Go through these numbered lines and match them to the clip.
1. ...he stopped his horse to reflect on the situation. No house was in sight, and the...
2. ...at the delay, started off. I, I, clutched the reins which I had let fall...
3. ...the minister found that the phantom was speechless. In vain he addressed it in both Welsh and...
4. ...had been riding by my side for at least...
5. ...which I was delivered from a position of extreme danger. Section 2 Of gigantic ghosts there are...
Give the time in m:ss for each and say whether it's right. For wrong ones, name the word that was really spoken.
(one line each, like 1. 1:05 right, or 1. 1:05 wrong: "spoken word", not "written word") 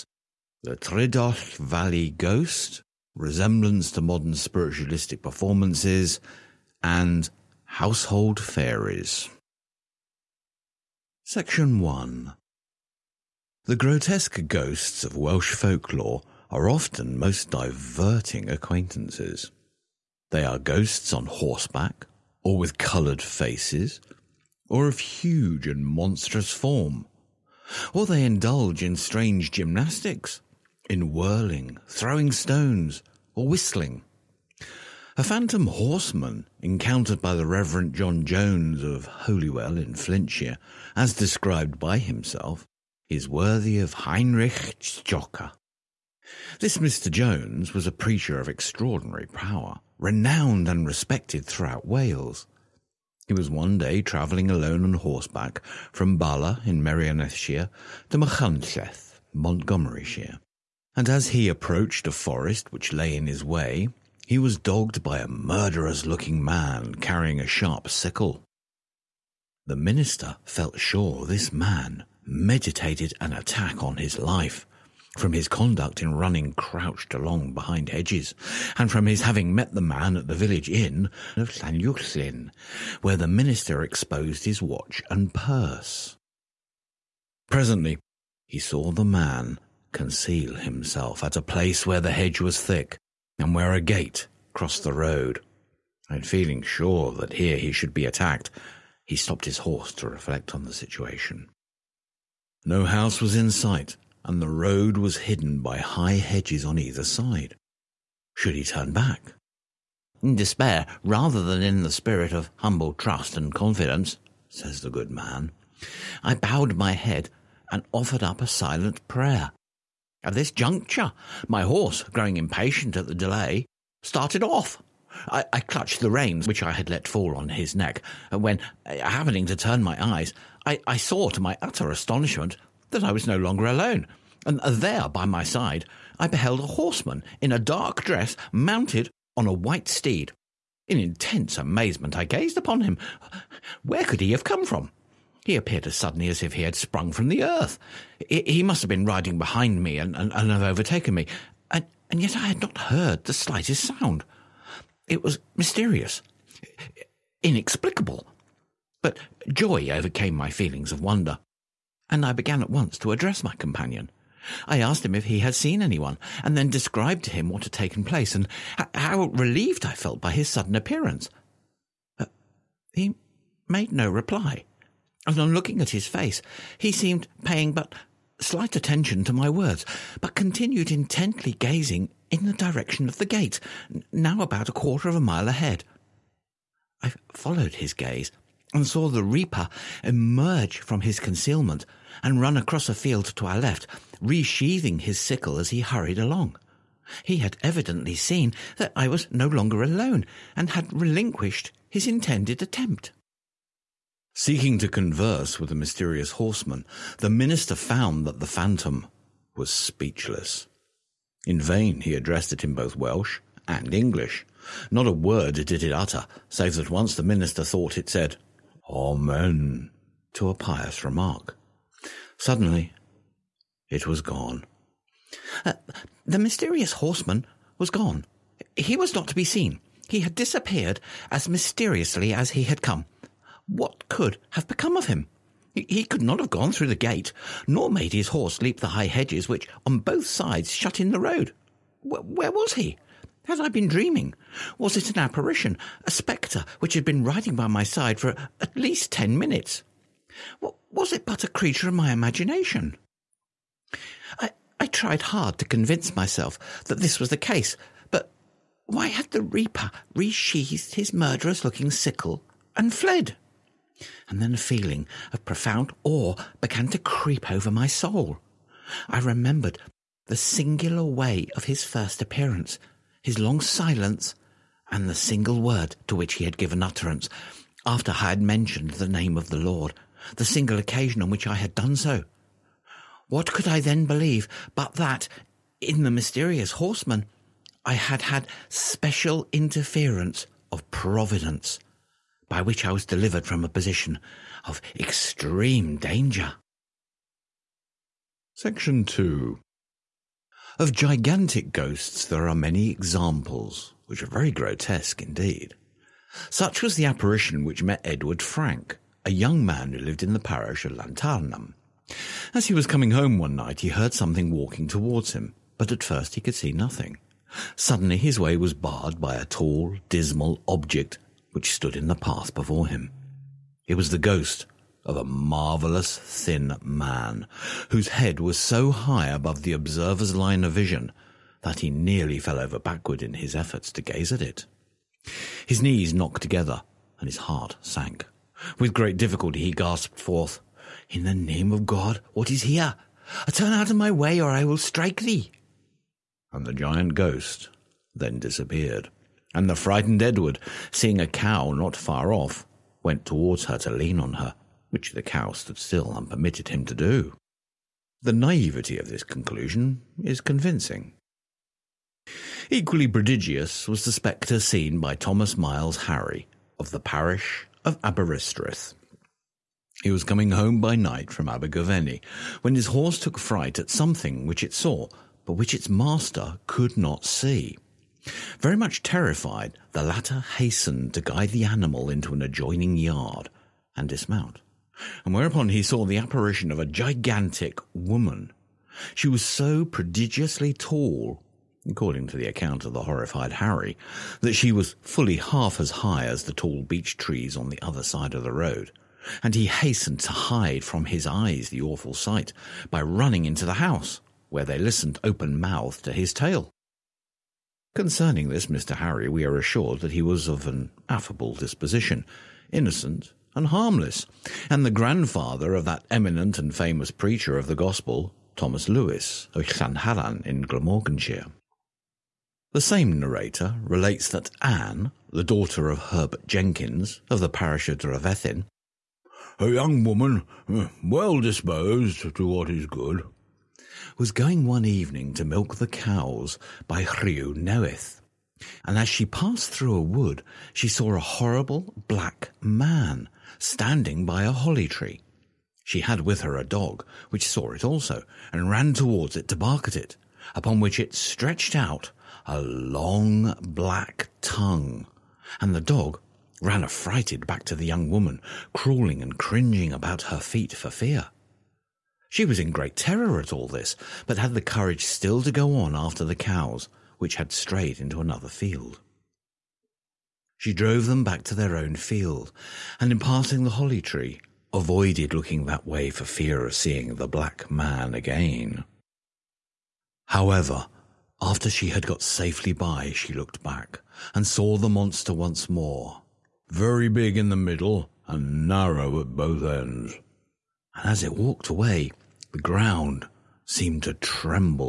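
1. 1:39 right
2. 2:02 right
3. 3:27 right
4. 4:06 right
5. 4:52 right.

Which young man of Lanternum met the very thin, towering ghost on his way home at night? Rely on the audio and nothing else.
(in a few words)
Edward Frank.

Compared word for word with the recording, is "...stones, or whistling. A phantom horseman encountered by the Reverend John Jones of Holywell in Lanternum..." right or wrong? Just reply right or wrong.
wrong.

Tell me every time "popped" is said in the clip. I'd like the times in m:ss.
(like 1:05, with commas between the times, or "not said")
not said.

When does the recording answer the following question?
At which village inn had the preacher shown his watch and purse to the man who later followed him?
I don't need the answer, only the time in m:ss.
1:21.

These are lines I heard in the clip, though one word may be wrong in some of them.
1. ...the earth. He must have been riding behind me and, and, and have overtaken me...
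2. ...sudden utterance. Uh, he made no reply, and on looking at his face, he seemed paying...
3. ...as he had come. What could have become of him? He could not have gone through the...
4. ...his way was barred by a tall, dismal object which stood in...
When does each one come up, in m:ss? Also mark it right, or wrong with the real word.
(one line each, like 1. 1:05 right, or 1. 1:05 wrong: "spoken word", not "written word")
1. 2:27 right
2. 2:50 wrong: "appearance", not "utterance"
3. 3:52 right
4. 5:18 right.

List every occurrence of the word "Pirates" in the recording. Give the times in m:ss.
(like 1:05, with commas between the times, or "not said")
not said.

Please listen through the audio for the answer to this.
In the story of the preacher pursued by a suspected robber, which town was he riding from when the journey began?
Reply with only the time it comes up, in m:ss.
0:56.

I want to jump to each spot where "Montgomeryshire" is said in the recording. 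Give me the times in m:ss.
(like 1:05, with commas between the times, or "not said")
0:59.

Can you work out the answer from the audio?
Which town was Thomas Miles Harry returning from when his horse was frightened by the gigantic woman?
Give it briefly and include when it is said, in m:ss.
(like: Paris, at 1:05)
Abergavenny, at 6:11.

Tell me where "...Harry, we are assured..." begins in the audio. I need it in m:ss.
6:48.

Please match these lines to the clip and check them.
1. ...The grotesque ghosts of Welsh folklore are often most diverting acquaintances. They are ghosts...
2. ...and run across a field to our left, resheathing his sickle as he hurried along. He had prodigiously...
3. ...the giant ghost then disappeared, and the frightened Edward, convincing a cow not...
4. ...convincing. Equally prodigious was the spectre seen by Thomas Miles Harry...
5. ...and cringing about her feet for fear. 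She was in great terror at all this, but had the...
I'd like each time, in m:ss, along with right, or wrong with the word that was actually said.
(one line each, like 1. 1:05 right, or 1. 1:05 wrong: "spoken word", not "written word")
1. 0:13 right
2. 3:12 wrong: "evidently", not "prodigiously"
3. 5:46 wrong: "seeing", not "convincing"
4. 6:00 right
5. 7:39 right.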